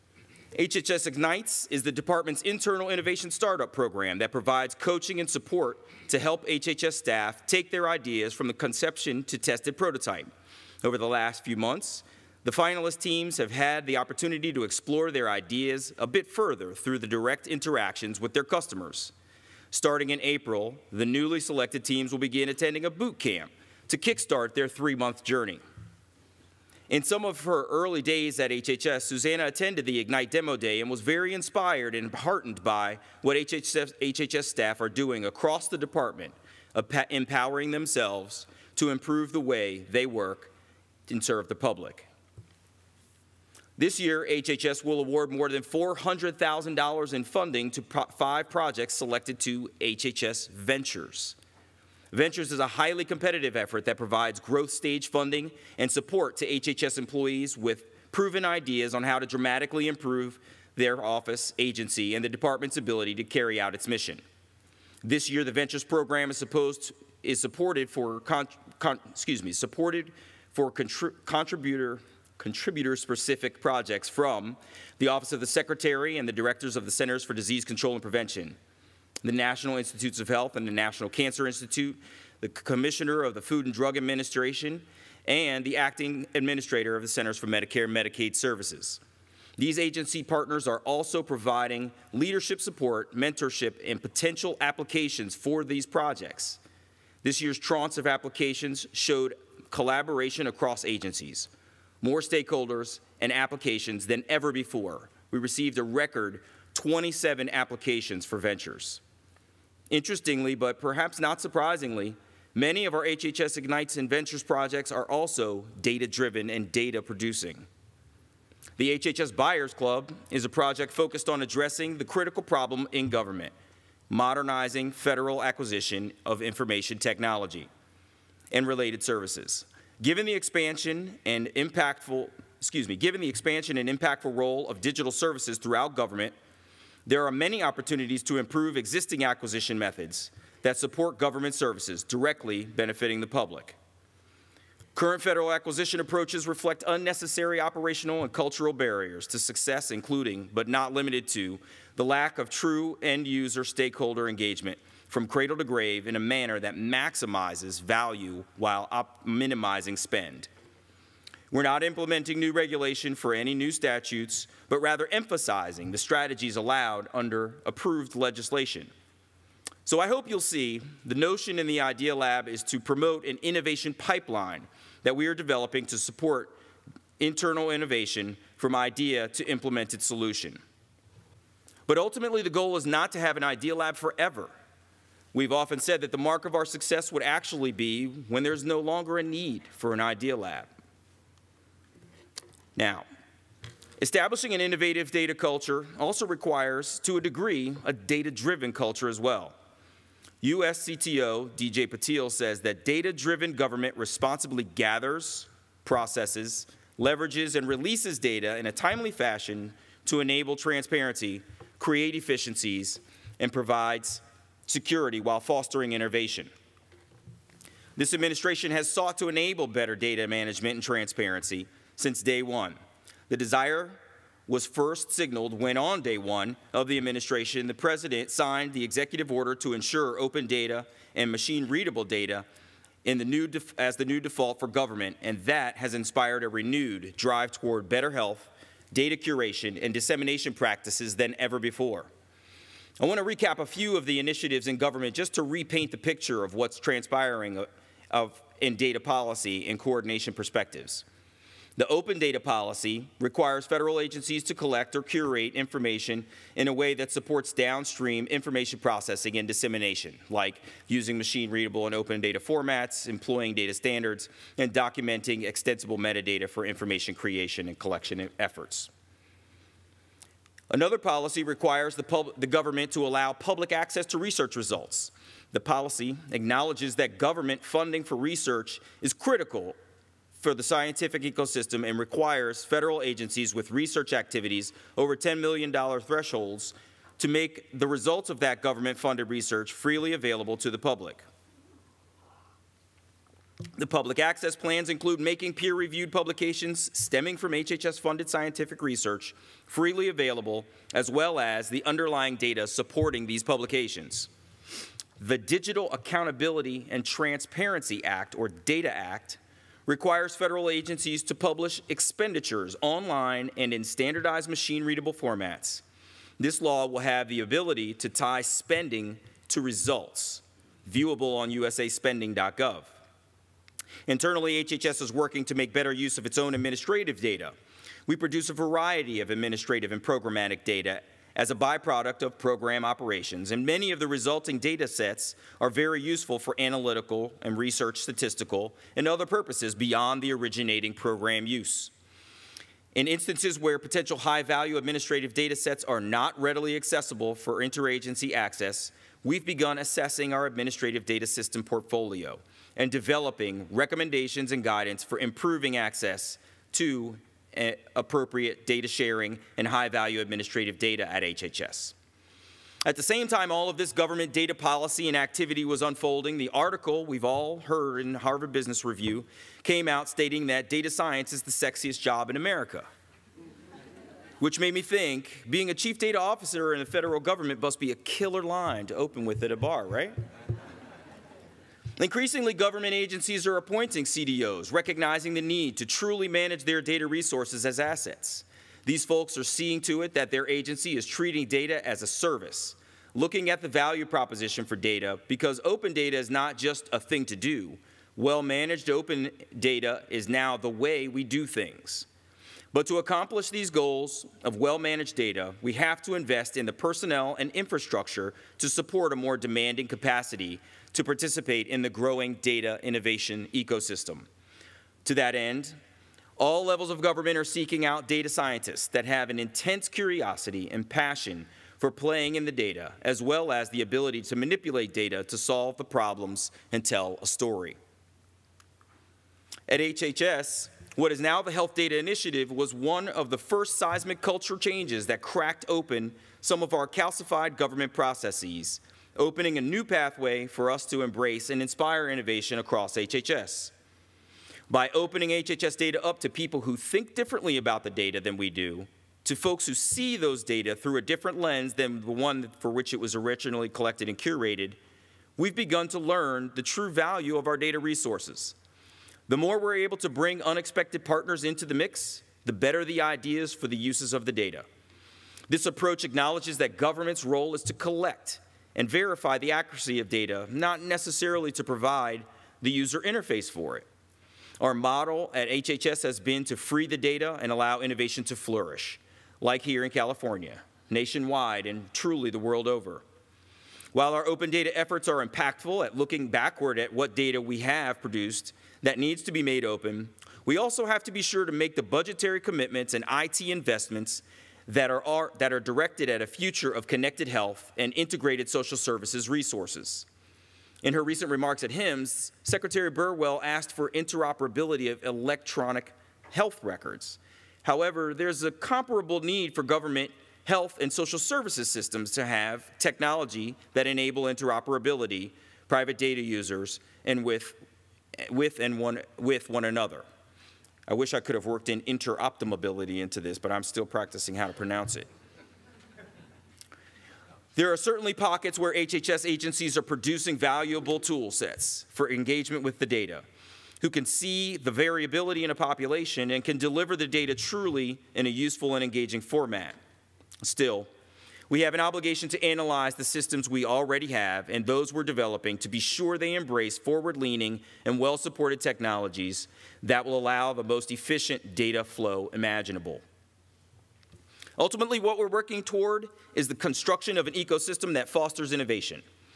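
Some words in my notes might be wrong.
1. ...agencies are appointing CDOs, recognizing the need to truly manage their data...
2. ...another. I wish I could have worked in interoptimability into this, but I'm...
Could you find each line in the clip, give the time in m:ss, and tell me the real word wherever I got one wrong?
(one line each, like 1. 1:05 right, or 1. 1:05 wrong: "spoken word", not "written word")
1. 6:22 right
2. 8:39 right.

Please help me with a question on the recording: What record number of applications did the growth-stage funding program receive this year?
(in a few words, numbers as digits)
27.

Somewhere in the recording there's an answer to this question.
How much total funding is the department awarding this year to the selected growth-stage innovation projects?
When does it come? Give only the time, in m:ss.
0:45.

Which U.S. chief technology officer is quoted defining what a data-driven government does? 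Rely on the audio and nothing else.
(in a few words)
DJ Patil.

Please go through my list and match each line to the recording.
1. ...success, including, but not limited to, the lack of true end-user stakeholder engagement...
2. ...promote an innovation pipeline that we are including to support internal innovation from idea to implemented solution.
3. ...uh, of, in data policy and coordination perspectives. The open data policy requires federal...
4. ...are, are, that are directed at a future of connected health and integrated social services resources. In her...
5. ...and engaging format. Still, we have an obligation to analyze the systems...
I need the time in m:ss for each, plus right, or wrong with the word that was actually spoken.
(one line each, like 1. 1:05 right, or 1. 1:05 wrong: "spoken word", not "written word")
1. 2:29 right
2. 2:52 wrong: "developing", not "including"
3. 4:07 right
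4. 8:14 right
5. 8:58 right.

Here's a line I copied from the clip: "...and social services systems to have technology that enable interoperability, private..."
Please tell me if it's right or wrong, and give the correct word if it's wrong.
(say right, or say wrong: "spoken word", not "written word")
right.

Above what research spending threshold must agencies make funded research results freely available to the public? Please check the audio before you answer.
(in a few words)
$10 million.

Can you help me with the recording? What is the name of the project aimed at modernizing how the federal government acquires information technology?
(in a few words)
HHS Buyers Club.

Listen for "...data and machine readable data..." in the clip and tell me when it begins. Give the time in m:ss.
3:50.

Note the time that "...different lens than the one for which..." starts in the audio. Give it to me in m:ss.
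7:31.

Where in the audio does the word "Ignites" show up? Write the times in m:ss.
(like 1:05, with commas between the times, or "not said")
0:01, 0:29, 1:53.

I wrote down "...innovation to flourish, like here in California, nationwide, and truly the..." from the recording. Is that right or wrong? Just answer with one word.
right.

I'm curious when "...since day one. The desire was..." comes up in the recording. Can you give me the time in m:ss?
3:42.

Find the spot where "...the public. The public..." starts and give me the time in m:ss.
4:50.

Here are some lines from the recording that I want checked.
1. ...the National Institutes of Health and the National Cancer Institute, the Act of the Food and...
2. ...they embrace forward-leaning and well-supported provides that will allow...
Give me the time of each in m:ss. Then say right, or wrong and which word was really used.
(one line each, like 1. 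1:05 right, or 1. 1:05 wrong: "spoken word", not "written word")
1. 1:19 wrong: "Commissioner", not "Act"
2. 9:06 wrong: "technologies", not "provides".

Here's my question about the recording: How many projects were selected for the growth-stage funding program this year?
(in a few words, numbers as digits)
5.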